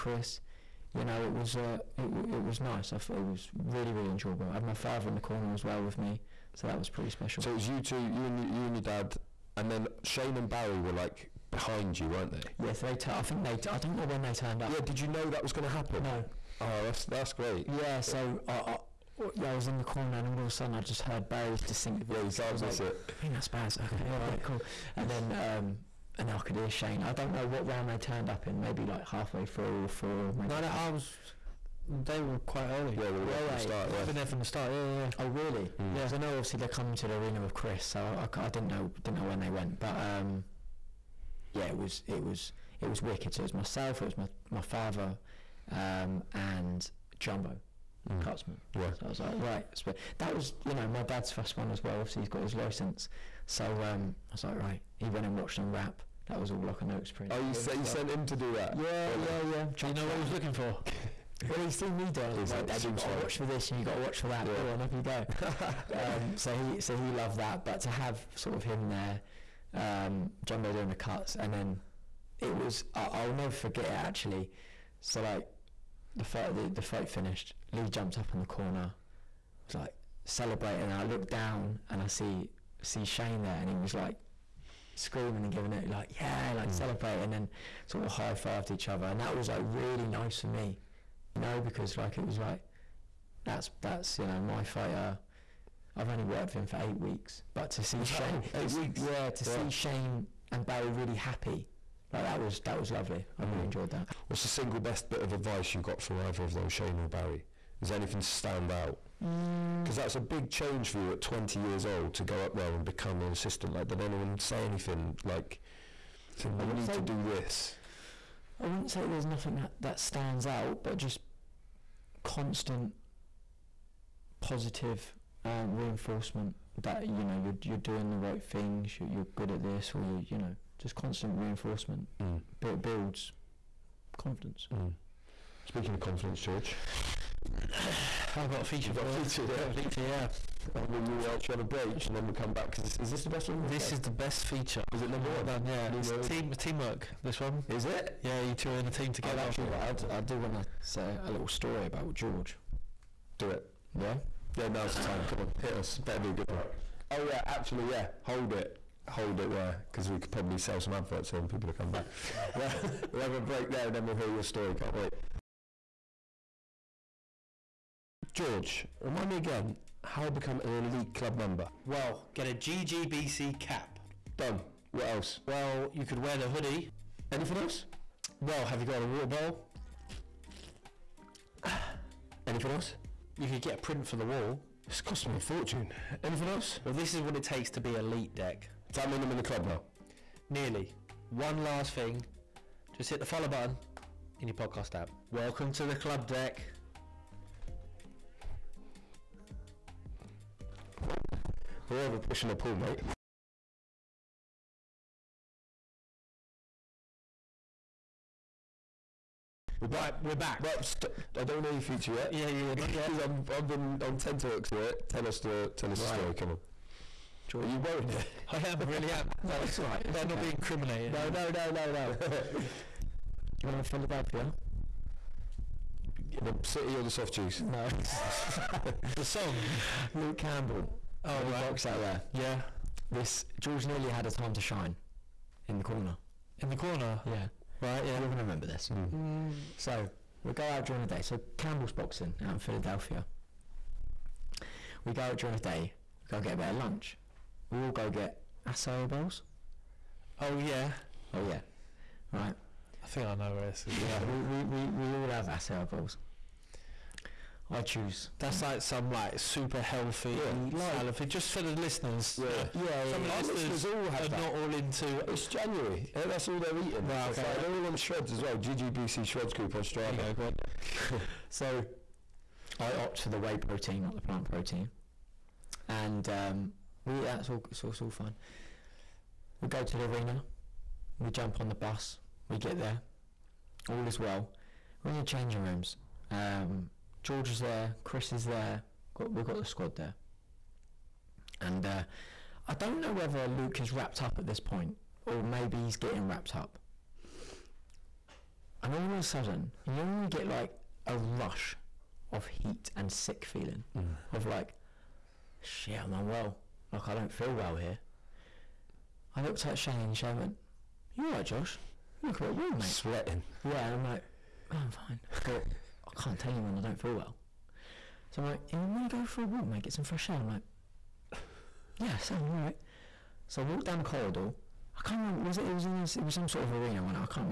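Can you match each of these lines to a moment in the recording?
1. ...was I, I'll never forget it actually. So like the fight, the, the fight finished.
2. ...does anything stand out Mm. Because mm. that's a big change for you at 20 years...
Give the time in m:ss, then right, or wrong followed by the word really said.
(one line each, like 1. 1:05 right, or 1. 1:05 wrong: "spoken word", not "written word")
1. 1:12 right
2. 1:47 right.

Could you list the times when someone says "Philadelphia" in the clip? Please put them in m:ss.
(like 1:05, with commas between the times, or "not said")
3:43, 4:02.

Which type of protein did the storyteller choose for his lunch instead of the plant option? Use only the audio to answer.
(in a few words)
Whey protein.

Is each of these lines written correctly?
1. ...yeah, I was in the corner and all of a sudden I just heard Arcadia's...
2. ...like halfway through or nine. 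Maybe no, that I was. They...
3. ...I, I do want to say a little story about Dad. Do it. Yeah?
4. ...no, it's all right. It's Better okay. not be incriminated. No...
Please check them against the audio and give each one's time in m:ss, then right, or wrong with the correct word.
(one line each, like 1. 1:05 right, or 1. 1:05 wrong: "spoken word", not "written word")
1. 0:19 wrong: "Barry", not "Arcadia"
2. 0:28 wrong: "four", not "nine"
3. 2:30 wrong: "George", not "Dad"
4. 3:39 right.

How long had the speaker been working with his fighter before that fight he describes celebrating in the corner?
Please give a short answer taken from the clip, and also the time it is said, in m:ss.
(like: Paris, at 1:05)
8 weeks, at 1:36.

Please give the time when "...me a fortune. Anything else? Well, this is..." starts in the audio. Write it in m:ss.
3:05.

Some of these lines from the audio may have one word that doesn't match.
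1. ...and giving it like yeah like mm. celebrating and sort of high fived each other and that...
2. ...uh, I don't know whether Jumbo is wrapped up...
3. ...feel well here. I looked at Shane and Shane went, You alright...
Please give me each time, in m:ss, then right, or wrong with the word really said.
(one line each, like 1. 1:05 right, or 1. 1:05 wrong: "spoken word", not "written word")
1. 1:25 right
2. 4:51 wrong: "Luke", not "Jumbo"
3. 5:07 right.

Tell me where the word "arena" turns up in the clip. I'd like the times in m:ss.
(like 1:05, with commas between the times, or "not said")
0:37, 4:40, 5:26.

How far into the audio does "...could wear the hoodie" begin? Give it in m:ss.
2:56.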